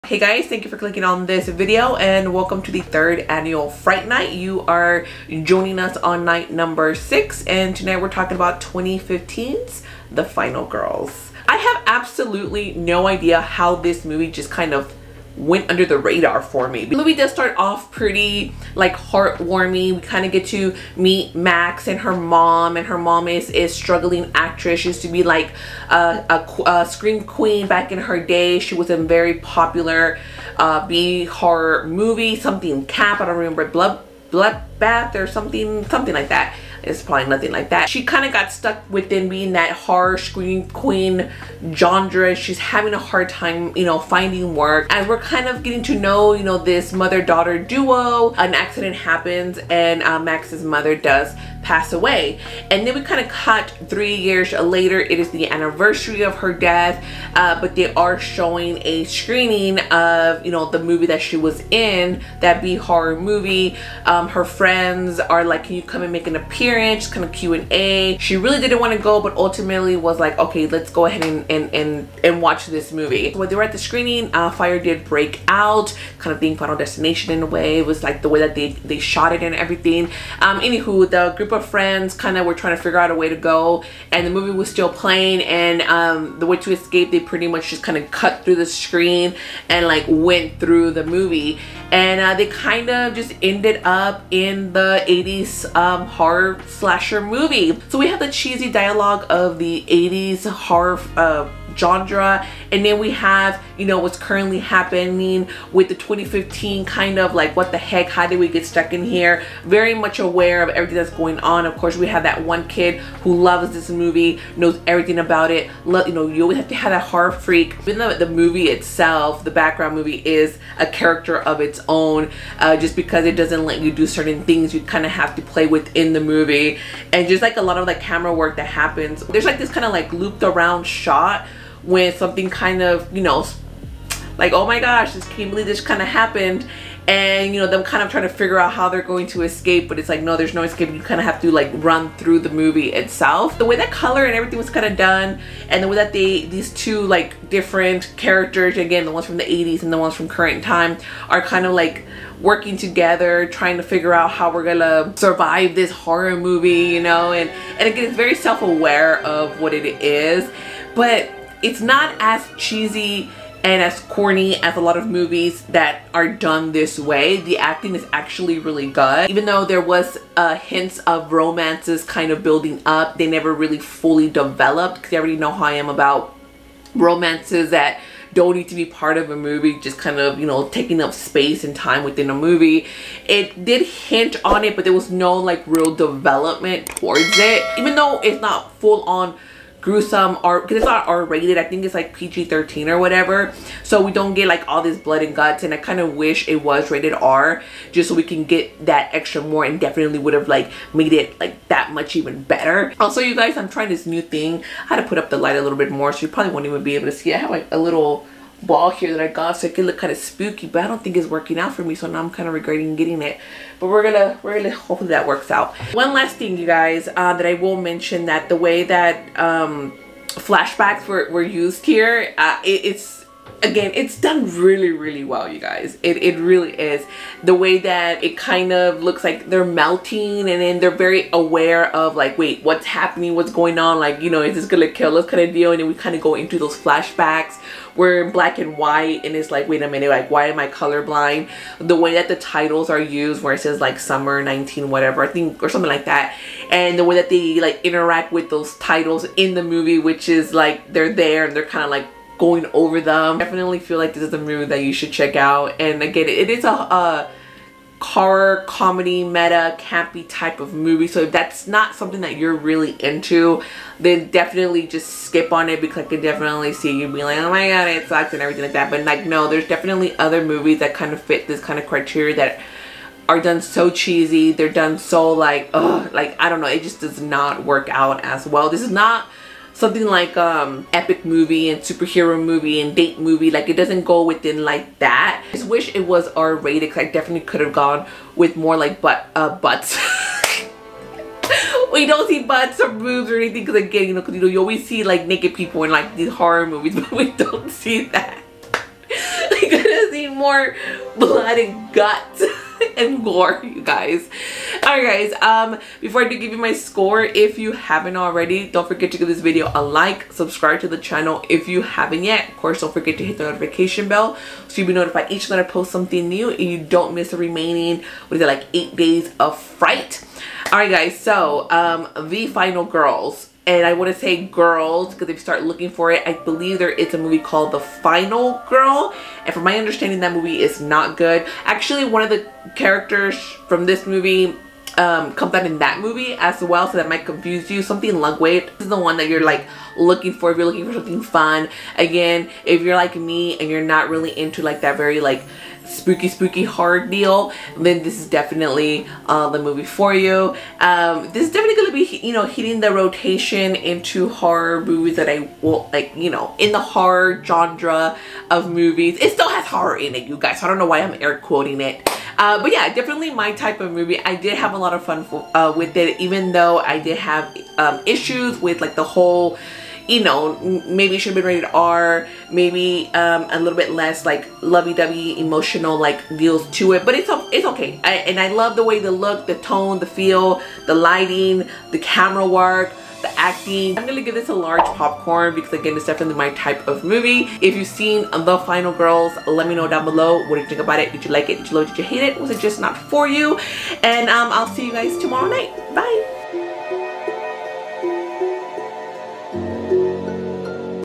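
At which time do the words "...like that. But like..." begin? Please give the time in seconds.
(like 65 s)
268 s.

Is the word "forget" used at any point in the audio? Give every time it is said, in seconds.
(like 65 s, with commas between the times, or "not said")
308 s, 312 s.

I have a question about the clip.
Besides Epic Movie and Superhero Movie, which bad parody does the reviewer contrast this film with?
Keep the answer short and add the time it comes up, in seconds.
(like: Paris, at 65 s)
Date Movie, at 282 s.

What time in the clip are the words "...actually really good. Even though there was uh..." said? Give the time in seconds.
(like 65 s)
168 s.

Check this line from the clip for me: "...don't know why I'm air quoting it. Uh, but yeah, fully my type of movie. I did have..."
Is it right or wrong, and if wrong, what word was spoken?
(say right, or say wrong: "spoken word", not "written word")
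wrong: "definitely", not "fully".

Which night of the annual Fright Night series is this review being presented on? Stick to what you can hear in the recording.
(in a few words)
6.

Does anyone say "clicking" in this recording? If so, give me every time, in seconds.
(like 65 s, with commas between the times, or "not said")
0 s.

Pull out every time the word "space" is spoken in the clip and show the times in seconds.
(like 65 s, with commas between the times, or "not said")
181 s.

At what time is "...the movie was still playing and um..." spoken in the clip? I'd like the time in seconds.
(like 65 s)
84 s.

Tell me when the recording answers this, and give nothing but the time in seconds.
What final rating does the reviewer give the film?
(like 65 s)
384 s.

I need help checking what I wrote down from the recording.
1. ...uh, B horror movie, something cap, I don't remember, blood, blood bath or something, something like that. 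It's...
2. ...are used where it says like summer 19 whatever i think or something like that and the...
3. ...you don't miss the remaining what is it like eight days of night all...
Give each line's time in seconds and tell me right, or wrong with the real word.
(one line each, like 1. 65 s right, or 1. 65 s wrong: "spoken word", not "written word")
1. 30 s right
2. 242 s right
3. 316 s wrong: "fright", not "night".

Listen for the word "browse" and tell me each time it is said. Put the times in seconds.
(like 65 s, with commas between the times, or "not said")
not said.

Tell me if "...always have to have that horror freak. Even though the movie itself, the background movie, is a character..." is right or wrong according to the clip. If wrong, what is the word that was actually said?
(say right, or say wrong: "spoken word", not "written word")
right.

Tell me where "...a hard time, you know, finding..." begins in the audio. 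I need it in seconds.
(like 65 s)
42 s.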